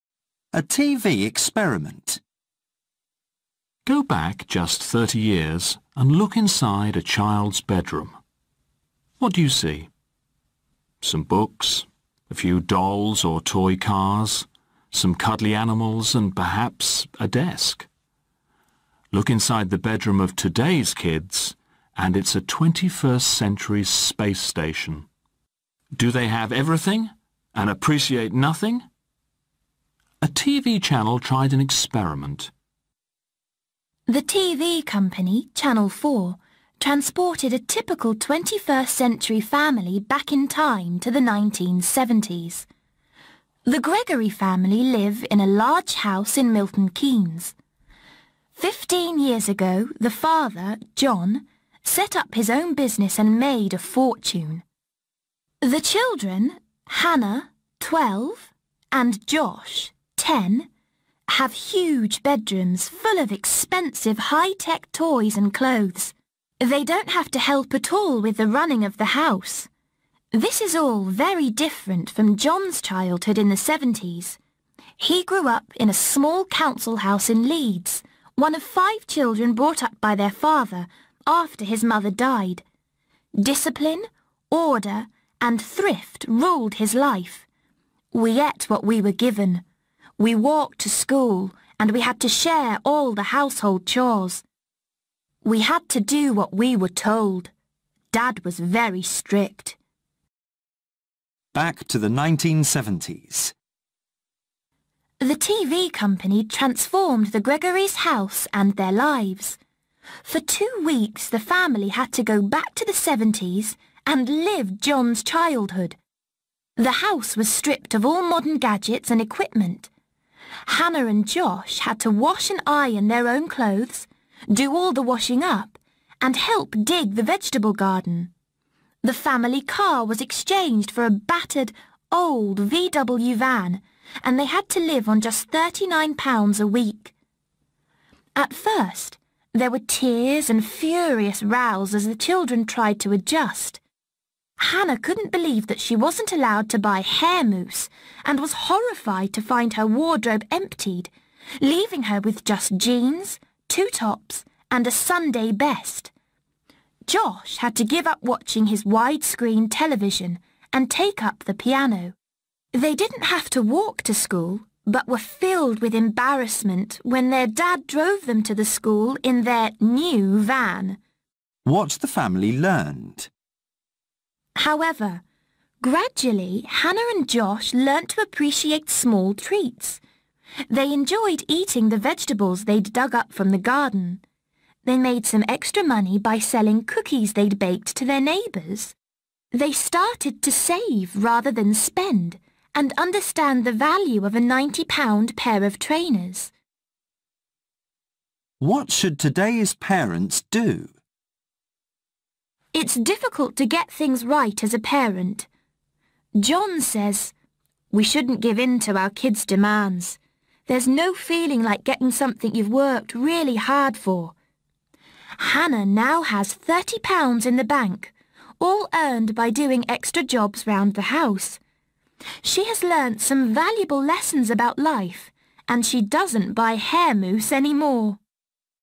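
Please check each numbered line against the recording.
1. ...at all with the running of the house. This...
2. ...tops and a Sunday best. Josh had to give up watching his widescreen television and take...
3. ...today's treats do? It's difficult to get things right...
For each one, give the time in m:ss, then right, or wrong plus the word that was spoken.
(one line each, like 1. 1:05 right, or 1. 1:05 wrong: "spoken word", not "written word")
1. 1:07 right
2. 2:33 right
3. 3:19 wrong: "parents", not "treats".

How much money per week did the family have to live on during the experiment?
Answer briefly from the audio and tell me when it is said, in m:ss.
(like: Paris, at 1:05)
£39, at 2:15.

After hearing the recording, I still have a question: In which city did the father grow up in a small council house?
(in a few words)
Leeds.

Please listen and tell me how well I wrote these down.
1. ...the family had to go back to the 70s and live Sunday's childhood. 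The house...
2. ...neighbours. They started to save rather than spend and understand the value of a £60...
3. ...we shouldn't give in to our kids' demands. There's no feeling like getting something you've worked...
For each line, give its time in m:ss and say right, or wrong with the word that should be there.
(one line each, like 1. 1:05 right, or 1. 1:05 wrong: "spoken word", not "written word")
1. 1:51 wrong: "John", not "Sunday"
2. 3:08 wrong: "90", not "60"
3. 3:27 right.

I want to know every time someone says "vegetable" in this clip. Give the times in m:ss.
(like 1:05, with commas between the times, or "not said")
2:07, 3:01.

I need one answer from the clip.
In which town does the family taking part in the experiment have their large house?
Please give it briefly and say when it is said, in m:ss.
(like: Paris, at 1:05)
Milton Keynes, at 0:46.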